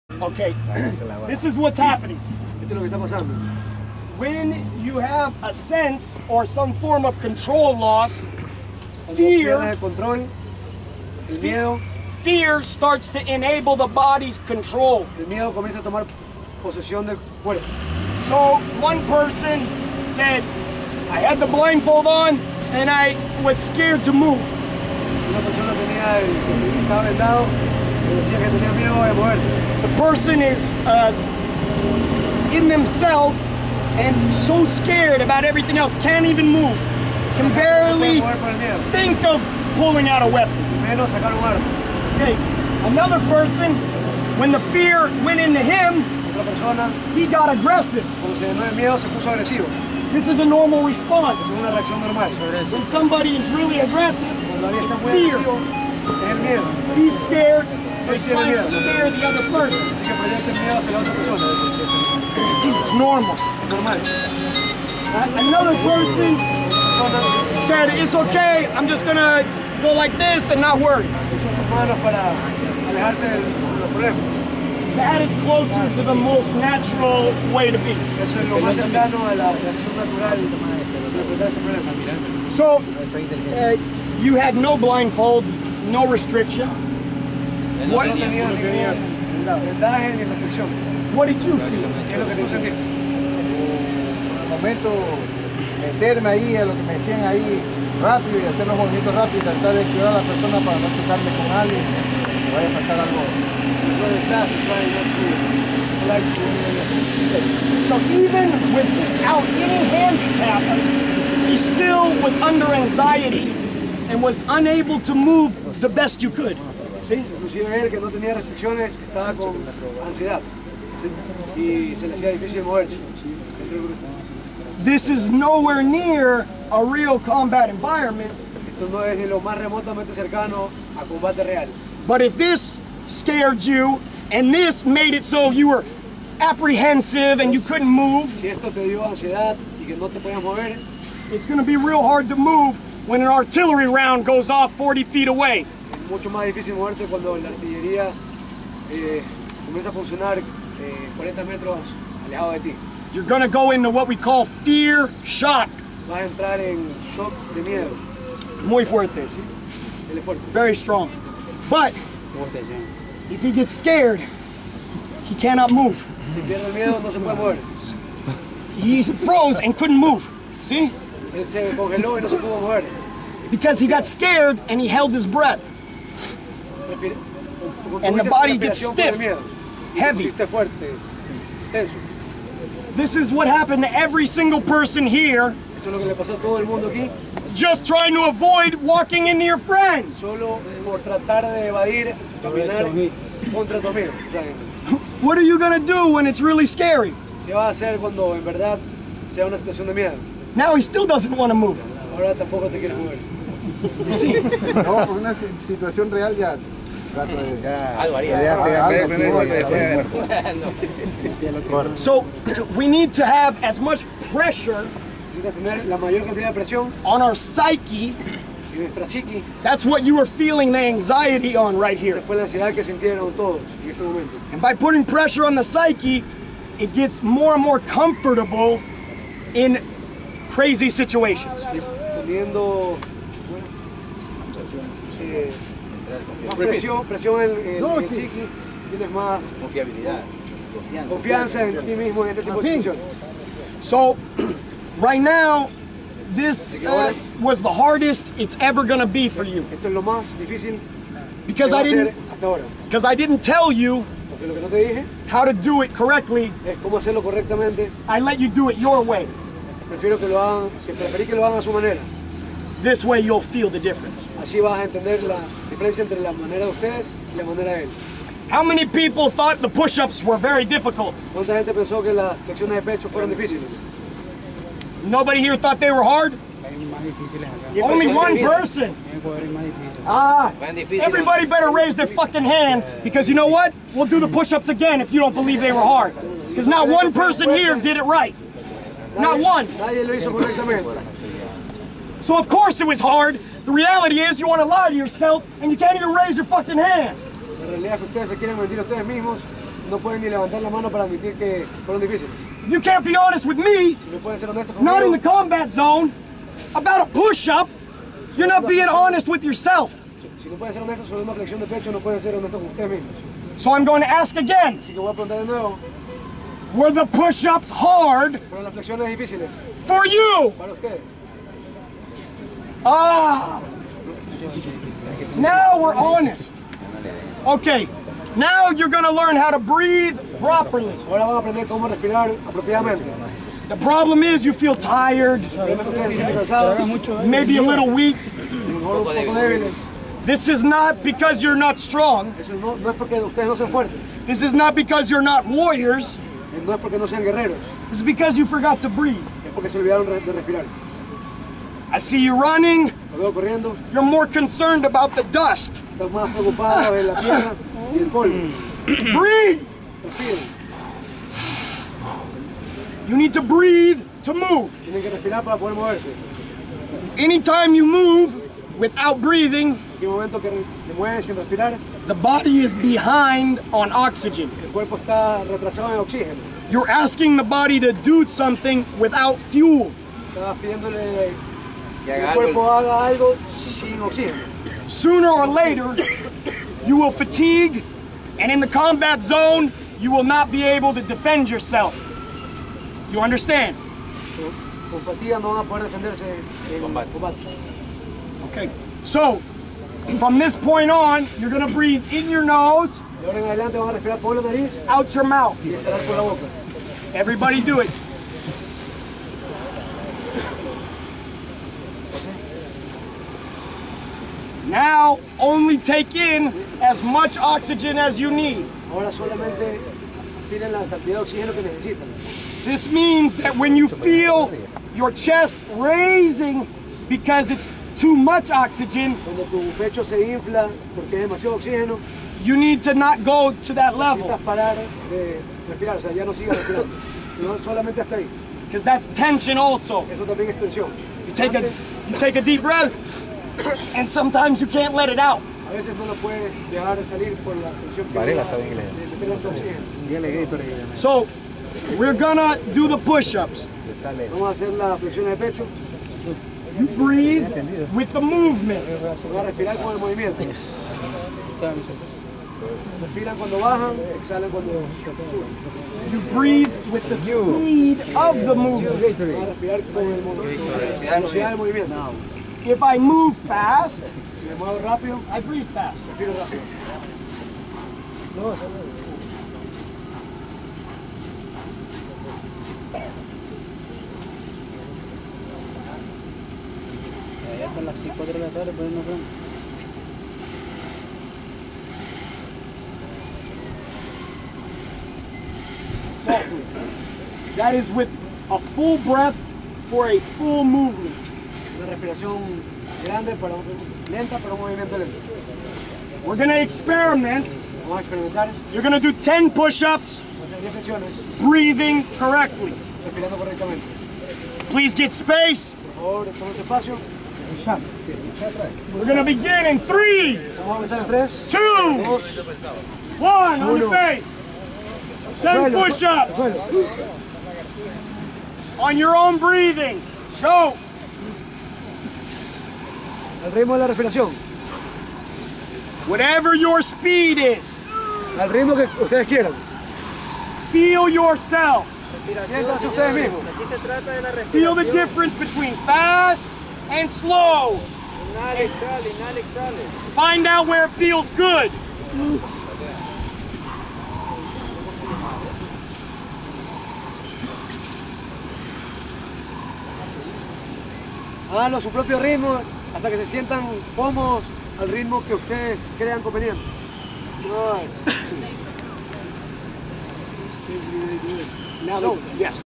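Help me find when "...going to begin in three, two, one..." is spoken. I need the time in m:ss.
8:39.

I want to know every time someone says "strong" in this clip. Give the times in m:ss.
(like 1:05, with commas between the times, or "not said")
2:40, 5:41.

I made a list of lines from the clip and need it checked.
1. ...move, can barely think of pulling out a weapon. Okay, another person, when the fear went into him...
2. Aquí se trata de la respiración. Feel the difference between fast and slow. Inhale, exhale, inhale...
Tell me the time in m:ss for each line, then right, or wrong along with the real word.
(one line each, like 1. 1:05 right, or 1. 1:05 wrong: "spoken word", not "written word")
1. 0:36 right
2. 9:03 right.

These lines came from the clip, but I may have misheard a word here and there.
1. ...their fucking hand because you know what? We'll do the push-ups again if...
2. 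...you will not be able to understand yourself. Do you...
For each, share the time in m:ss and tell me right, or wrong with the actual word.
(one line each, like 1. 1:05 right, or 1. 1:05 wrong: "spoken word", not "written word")
1. 4:41 right
2. 6:29 wrong: "defend", not "understand".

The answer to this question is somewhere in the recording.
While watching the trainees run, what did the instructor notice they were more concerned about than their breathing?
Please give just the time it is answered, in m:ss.
5:55.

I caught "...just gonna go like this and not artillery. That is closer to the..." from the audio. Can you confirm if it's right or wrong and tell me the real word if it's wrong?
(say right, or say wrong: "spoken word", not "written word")
wrong: "worry", not "artillery".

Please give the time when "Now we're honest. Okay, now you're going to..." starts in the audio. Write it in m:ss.
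5:25.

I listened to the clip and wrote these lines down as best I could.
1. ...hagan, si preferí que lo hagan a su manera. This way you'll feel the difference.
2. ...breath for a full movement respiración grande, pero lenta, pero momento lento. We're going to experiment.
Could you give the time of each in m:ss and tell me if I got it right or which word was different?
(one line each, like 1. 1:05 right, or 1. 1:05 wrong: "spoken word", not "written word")
1. 4:20 right
2. 8:18 wrong: "movimiento", not "momento".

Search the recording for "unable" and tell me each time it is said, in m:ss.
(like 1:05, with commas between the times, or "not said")
1:54.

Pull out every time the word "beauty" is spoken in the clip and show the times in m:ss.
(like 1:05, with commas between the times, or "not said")
not said.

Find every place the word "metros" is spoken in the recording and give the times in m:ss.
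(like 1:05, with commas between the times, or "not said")
2:31.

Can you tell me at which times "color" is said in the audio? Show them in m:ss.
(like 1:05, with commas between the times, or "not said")
not said.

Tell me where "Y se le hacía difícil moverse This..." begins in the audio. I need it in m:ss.
2:01.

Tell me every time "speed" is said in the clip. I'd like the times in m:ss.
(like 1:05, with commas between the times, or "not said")
7:47, 8:56.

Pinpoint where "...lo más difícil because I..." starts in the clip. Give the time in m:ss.
4:09.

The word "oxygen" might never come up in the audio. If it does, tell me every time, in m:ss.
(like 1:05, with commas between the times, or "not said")
6:13, 6:57, 7:08.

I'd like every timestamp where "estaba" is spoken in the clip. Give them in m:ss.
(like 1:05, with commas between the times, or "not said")
1:58.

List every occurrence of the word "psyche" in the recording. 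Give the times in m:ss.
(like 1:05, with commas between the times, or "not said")
3:37, 3:45.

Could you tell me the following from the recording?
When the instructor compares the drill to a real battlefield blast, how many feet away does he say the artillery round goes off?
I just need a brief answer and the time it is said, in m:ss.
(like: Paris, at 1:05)
40, at 2:24.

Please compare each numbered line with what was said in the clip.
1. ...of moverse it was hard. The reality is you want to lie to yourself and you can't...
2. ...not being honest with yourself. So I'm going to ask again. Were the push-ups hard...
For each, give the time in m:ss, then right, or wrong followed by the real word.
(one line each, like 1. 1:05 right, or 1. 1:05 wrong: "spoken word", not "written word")
1. 4:52 wrong: "course", not "moverse"
2. 5:08 right.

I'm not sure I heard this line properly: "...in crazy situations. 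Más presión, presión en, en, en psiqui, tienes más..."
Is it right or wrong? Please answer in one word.
right.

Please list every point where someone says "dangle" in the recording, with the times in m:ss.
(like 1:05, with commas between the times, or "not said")
not said.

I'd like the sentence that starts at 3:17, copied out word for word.
Now he still doesn't want to move.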